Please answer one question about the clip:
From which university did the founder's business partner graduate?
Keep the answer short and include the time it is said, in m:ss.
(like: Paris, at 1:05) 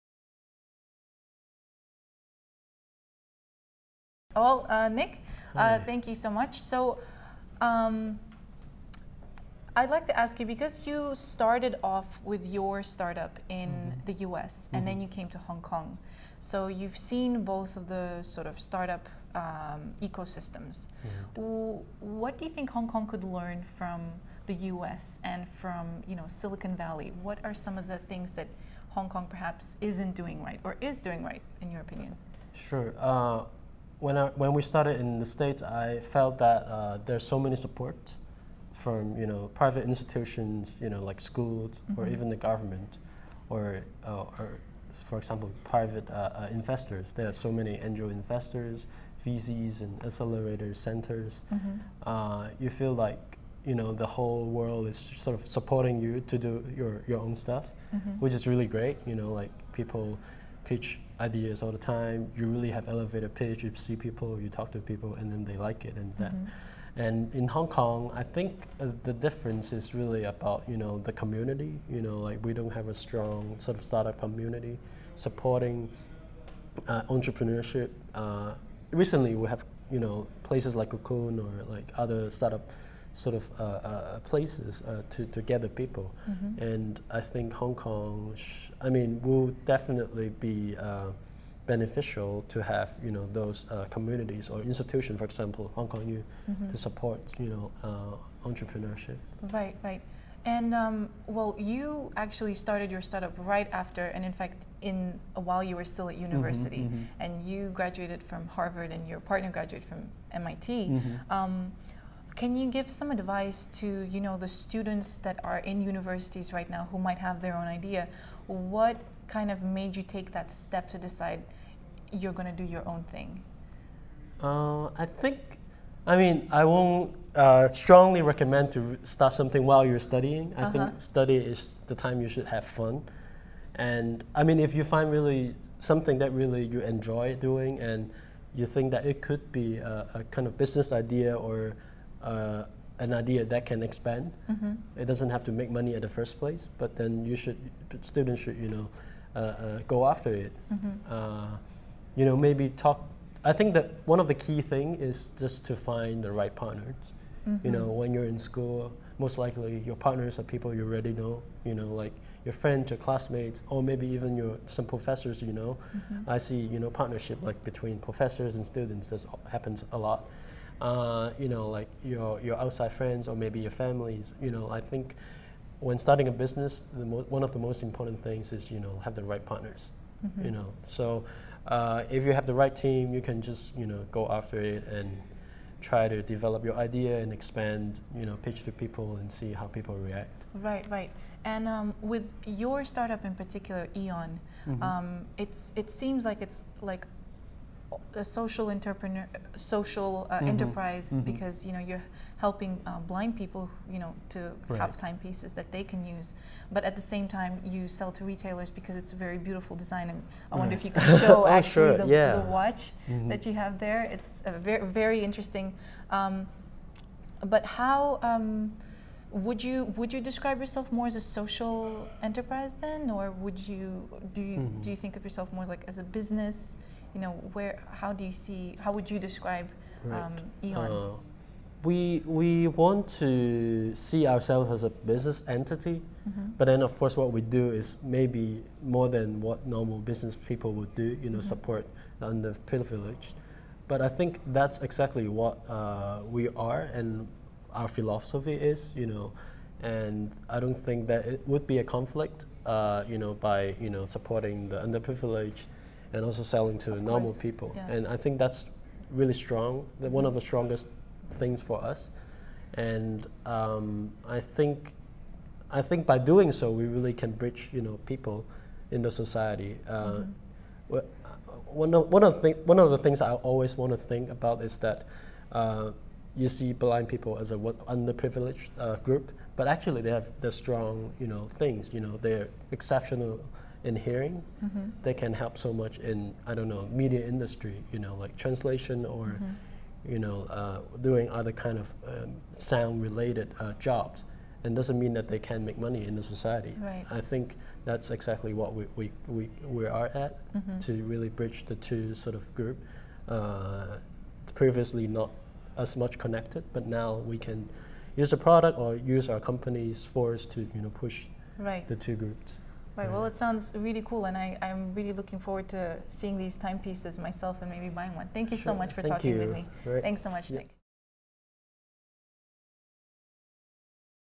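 MIT, at 1:50.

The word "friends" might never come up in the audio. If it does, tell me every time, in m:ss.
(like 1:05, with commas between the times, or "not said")
2:42, 2:52.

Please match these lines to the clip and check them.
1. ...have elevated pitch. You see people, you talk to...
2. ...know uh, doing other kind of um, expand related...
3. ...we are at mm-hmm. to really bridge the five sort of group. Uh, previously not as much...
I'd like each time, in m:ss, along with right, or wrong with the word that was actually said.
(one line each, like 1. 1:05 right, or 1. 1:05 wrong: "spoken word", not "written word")
1. 1:02 right
2. 4:50 wrong: "sound", not "expand"
3. 4:59 wrong: "two", not "five".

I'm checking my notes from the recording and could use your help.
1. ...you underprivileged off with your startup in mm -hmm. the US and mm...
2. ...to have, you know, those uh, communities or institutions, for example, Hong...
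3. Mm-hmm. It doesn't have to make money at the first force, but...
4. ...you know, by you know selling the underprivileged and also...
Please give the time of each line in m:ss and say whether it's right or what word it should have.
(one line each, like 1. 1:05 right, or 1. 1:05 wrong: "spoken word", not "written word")
1. 0:10 wrong: "started", not "underprivileged"
2. 1:32 right
3. 2:24 wrong: "place", not "force"
4. 4:13 wrong: "supporting", not "selling".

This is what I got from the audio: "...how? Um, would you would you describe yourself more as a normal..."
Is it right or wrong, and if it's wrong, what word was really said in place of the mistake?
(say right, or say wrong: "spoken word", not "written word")
wrong: "social", not "normal".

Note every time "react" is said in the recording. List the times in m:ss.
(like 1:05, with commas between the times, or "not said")
3:10.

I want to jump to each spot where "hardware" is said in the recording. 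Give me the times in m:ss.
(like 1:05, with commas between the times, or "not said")
not said.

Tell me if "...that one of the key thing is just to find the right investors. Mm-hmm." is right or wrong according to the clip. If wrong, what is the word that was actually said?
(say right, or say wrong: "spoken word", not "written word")
wrong: "partners", not "investors".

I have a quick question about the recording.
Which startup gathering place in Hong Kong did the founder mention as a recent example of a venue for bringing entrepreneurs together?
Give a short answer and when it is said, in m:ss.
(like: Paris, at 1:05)
Cocoon, at 1:20.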